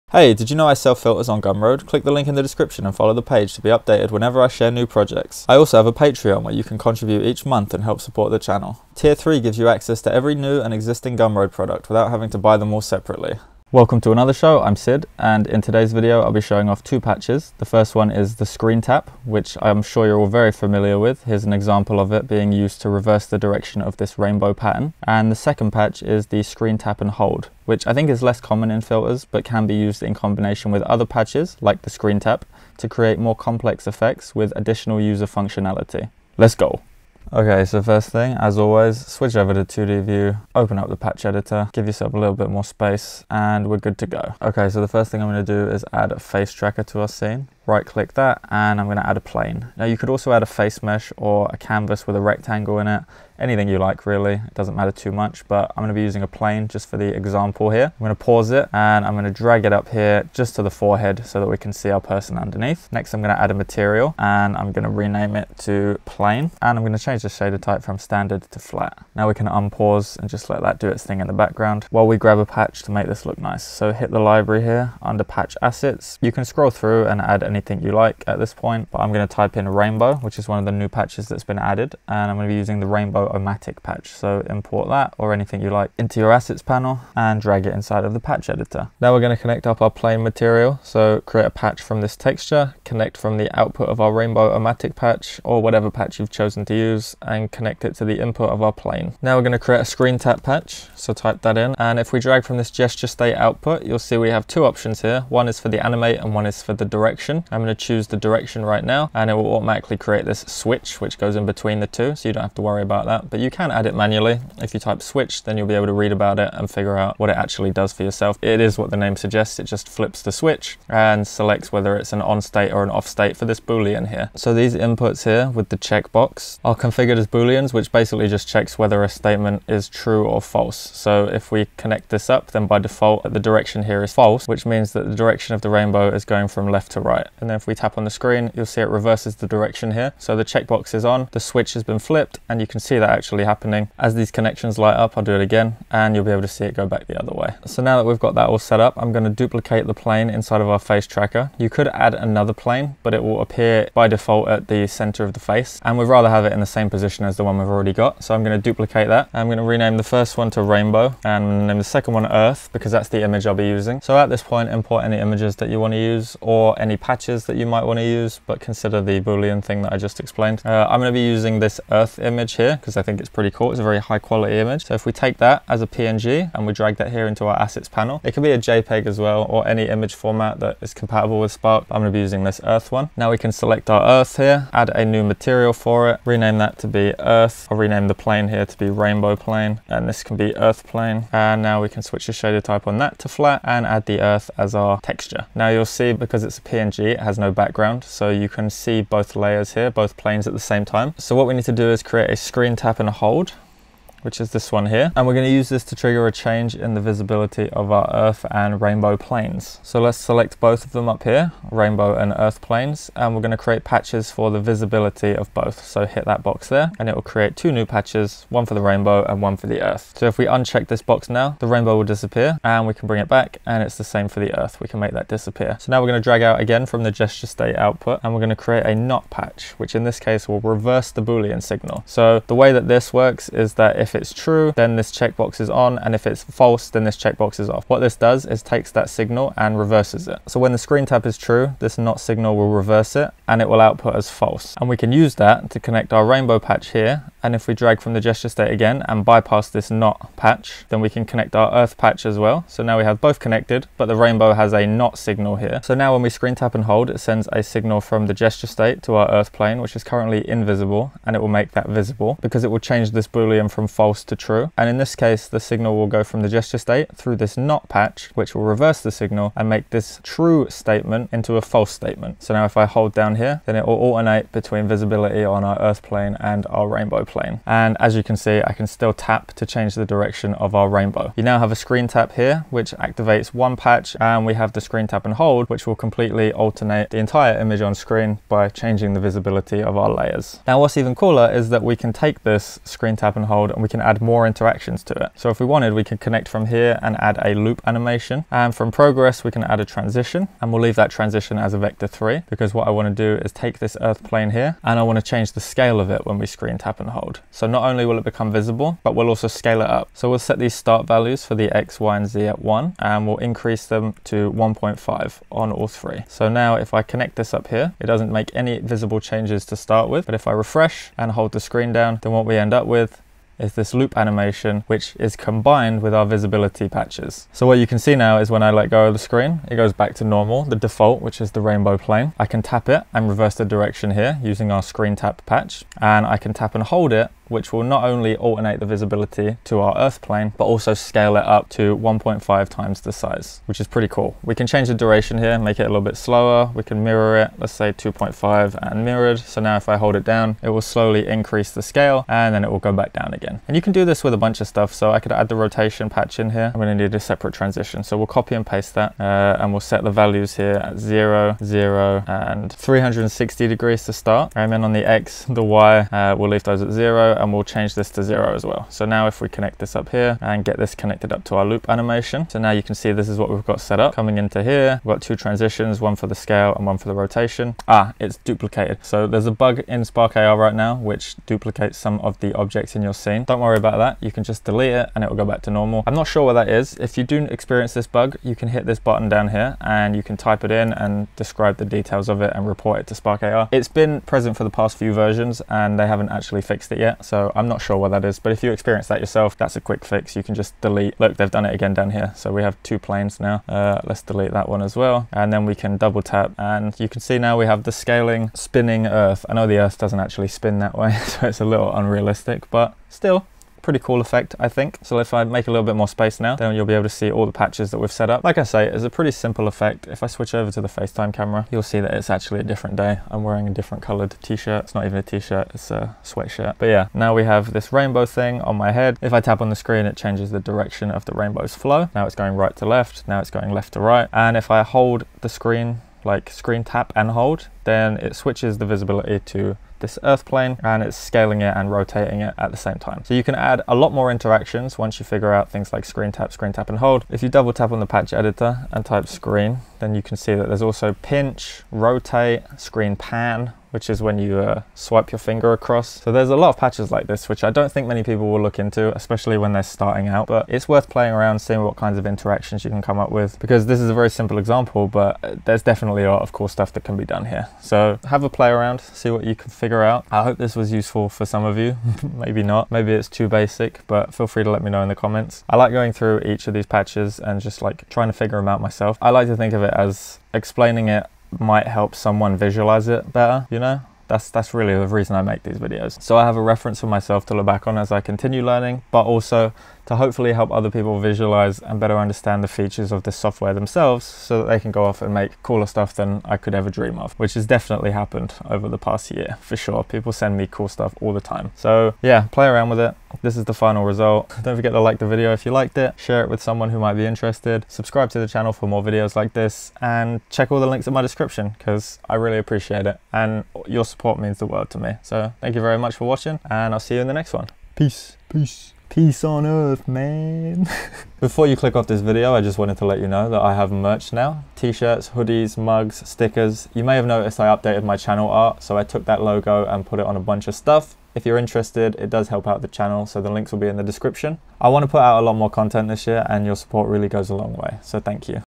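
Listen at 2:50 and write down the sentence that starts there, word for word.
Uh, I'm gonna be using this earth image here because because I think it's pretty cool.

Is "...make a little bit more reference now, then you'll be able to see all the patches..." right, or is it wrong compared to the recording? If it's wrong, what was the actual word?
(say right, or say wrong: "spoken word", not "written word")
wrong: "space", not "reference".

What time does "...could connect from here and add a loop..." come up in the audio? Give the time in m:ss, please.
4:56.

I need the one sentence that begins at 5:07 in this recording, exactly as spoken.
So not only will it become visible, but we'll also scale it up.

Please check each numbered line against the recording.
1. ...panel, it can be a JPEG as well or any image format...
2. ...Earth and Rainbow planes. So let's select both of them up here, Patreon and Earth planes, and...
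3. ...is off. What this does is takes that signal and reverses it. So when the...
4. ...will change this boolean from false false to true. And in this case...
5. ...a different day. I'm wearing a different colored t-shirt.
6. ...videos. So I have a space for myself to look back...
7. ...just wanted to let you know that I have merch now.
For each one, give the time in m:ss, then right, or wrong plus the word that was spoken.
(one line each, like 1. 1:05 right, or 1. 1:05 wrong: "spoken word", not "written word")
1. 2:57 right
2. 3:28 wrong: "Rainbow", not "Patreon"
3. 3:57 right
4. 4:22 right
5. 7:02 right
6. 8:05 wrong: "reference", not "space"
7. 8:42 right.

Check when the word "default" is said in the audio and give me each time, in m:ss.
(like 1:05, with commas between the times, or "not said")
2:12, 2:34, 5:30.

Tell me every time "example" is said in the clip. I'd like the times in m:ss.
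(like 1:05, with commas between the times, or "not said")
0:21, 0:57, 7:44.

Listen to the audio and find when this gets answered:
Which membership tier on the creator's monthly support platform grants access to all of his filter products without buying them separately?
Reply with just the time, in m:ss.
0:08.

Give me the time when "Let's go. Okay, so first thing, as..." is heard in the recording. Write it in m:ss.
0:36.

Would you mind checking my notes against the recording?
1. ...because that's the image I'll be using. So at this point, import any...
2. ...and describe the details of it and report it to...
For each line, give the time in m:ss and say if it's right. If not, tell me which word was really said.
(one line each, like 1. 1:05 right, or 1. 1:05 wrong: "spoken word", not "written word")
1. 2:42 right
2. 6:30 right.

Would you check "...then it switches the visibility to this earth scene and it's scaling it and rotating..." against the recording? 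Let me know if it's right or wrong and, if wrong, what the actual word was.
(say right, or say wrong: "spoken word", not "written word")
wrong: "plane", not "scene".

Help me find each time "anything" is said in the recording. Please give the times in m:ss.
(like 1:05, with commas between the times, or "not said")
0:53, 1:17, 1:25.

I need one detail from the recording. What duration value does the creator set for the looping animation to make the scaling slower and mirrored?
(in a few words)
2.5.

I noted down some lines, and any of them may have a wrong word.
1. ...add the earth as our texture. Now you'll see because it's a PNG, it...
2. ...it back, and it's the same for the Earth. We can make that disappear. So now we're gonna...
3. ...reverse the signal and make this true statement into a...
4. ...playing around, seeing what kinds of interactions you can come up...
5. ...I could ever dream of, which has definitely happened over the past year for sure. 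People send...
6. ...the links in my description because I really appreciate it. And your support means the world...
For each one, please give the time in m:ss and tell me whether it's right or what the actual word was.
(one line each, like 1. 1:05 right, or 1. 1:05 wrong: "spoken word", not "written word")
1. 3:13 right
2. 3:43 right
3. 4:28 right
4. 7:41 right
5. 8:16 right
6. 8:30 right.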